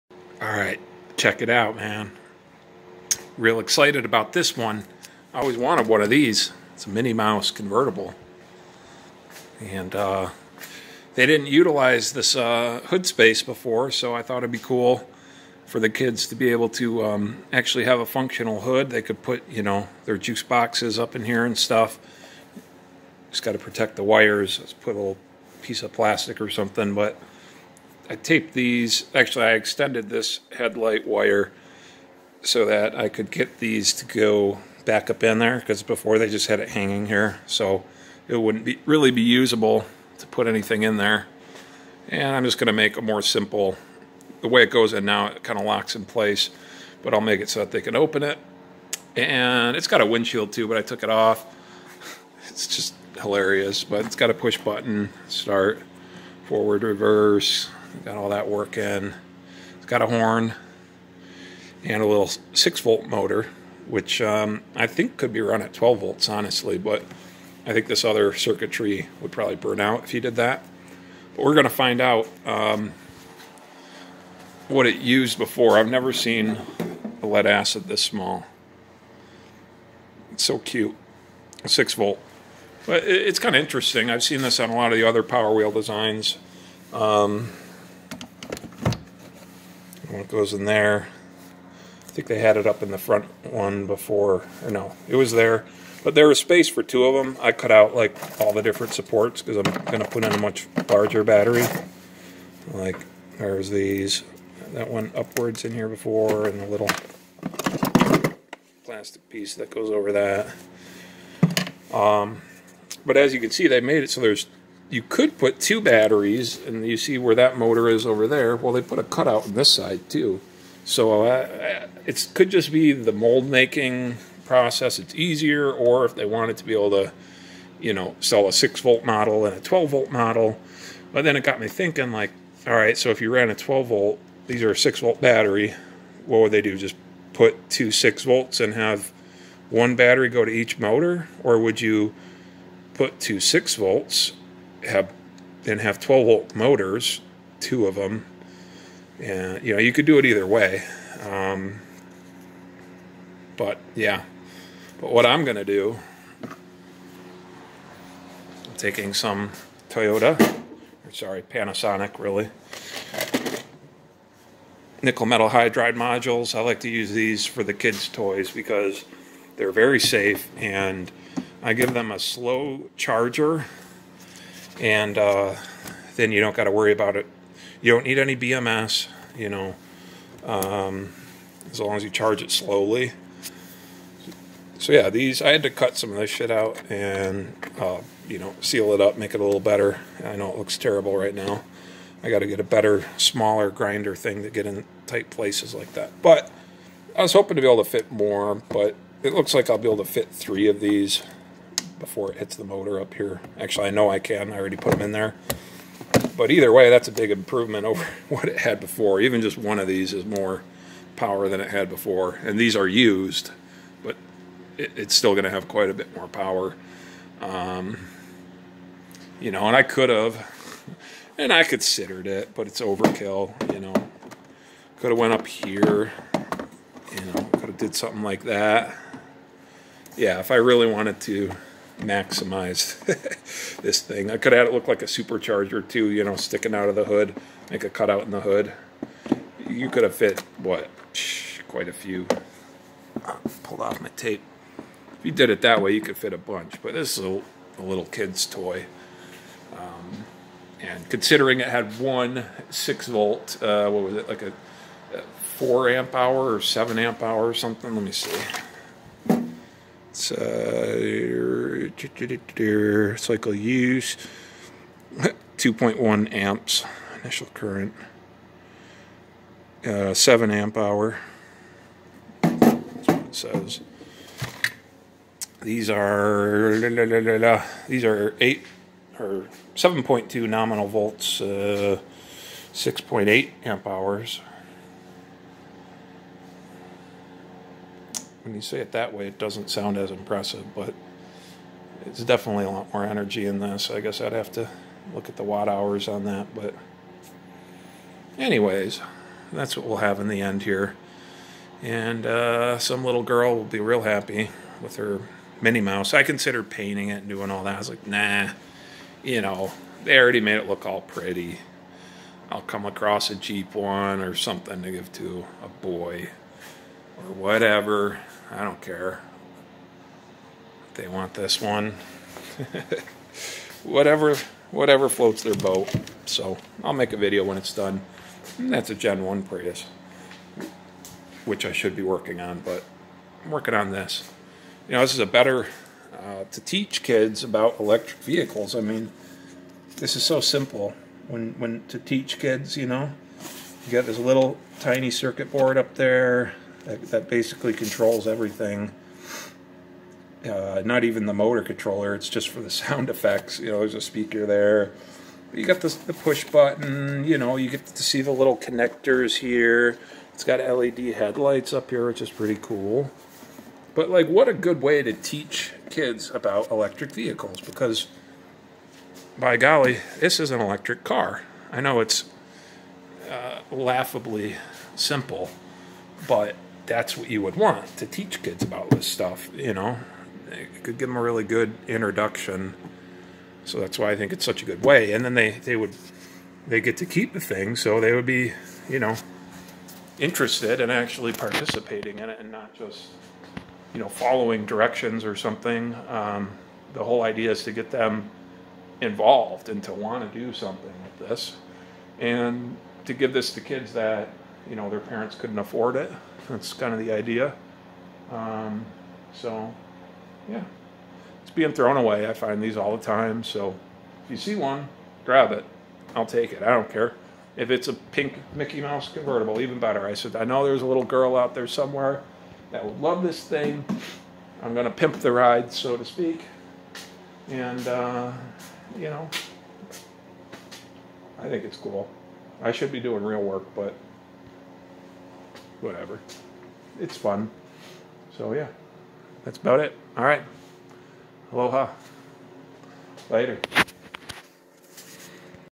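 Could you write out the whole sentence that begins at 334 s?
You know, this is a better uh, to teach kids about electric vehicles.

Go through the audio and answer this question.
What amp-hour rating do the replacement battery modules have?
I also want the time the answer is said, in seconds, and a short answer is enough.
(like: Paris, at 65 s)
6.8 amp hours, at 282 s.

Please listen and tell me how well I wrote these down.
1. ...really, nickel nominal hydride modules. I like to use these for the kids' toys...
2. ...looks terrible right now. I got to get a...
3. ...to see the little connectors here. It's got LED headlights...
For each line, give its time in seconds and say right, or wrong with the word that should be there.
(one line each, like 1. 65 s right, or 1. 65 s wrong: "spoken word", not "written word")
1. 162 s wrong: "metal", not "nominal"
2. 190 s right
3. 357 s right.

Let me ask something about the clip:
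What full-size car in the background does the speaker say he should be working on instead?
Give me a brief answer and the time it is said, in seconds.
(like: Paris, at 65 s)
Gen 1 Prius, at 328 s.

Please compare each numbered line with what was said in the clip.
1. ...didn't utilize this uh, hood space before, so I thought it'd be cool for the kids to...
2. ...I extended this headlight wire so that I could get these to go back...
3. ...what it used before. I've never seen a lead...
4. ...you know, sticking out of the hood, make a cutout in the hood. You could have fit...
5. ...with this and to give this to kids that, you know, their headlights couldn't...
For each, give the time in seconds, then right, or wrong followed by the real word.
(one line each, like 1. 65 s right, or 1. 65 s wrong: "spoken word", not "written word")
1. 11 s right
2. 29 s right
3. 74 s right
4. 236 s right
5. 401 s wrong: "parents", not "headlights".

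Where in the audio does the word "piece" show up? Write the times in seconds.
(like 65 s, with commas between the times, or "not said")
25 s, 109 s.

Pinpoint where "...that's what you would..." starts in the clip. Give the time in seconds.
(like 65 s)
376 s.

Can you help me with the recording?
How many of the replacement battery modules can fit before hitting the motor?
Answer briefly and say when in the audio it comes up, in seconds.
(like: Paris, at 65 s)
3, at 200 s.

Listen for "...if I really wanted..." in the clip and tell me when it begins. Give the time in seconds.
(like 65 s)
230 s.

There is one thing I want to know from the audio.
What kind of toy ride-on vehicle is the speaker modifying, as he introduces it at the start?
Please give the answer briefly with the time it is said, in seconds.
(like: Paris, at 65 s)
Minnie Mouse convertible, at 6 s.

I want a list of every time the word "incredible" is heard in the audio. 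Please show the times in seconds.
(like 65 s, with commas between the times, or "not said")
not said.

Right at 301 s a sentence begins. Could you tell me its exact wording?
And uh, some little girl will be real happy with her Minnie Mouse.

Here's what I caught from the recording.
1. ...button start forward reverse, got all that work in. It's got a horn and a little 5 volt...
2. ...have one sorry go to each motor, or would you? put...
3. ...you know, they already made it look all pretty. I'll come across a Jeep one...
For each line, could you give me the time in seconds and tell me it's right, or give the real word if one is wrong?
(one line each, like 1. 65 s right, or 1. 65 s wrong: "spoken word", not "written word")
1. 54 s wrong: "6", not "5"
2. 138 s wrong: "battery", not "sorry"
3. 309 s right.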